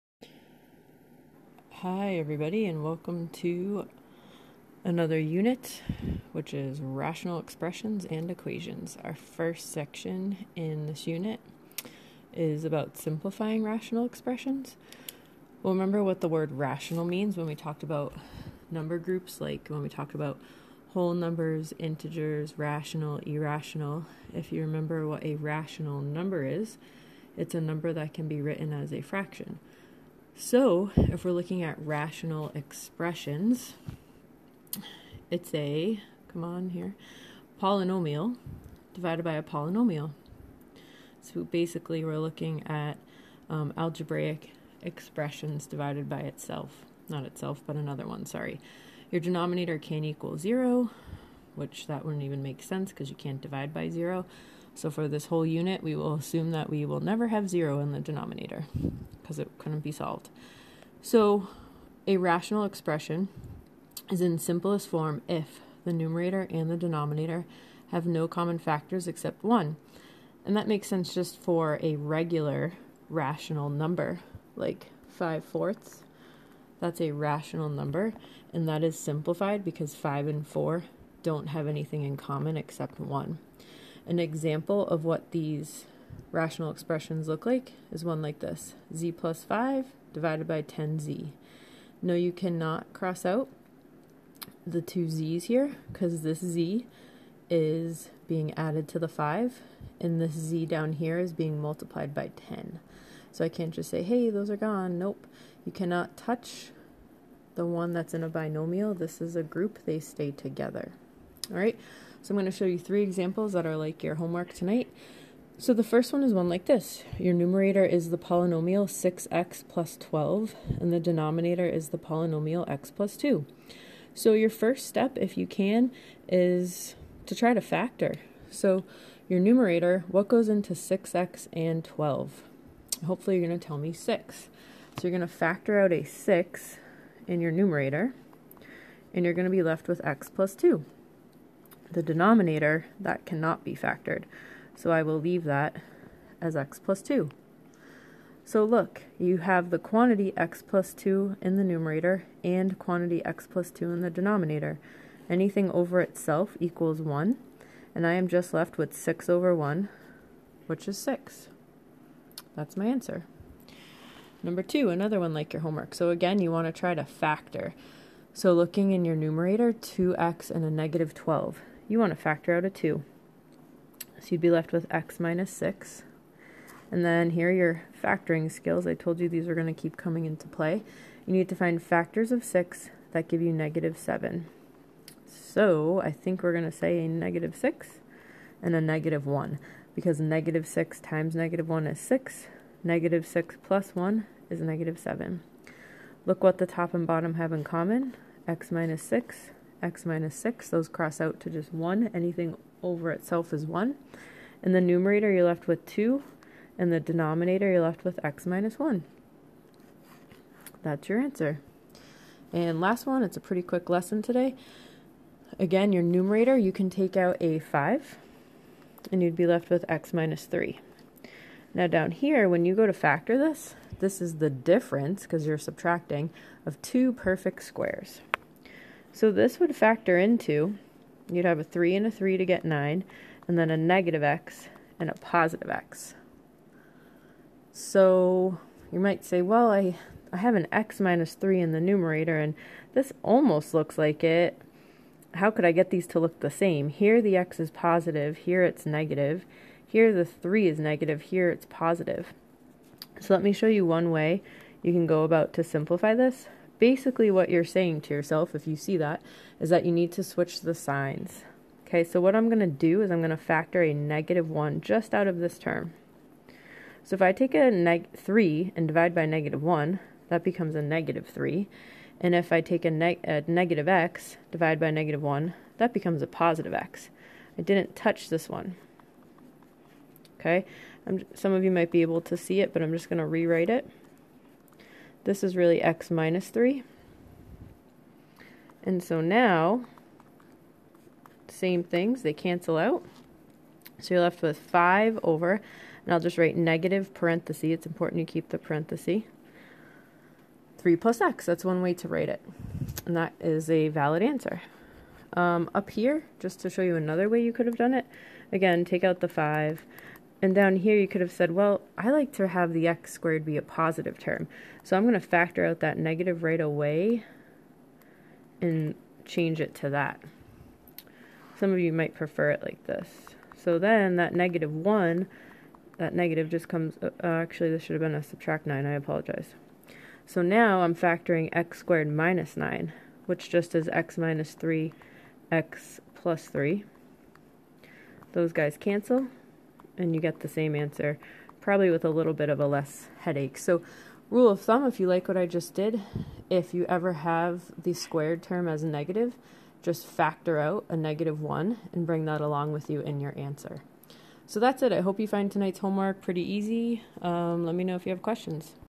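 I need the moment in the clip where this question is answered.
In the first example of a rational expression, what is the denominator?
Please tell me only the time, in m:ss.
1:30.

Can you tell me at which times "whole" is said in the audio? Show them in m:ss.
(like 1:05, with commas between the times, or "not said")
0:20, 0:55.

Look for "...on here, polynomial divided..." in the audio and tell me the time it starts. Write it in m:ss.
0:36.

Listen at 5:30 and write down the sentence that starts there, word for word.
So now I'm factoring x squared minus 9, which just is x minus 3, x plus 3.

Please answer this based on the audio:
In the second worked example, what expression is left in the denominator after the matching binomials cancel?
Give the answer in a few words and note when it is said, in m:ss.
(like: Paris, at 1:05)
x - 1, at 3:28.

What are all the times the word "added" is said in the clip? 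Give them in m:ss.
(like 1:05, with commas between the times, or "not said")
1:38.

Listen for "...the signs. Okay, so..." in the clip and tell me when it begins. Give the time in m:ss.
4:20.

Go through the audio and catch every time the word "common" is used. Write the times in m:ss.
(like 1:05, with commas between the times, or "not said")
1:08, 1:22, 3:17.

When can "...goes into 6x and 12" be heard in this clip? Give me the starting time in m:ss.
2:10.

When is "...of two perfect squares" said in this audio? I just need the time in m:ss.
3:46.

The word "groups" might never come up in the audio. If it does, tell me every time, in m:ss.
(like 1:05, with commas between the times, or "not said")
0:18, 1:49.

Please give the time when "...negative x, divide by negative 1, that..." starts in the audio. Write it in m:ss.
4:33.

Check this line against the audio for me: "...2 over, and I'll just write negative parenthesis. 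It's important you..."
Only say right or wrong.
wrong.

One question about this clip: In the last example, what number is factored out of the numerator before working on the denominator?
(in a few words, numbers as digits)
5.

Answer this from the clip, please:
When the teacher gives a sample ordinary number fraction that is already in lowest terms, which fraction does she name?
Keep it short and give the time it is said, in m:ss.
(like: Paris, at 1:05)
5/4, at 1:15.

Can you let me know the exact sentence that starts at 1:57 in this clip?
Your numerator is the polynomial 6x plus 12, and the denominator is the polynomial x plus 2.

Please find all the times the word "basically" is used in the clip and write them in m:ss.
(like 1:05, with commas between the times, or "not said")
0:41, 4:16.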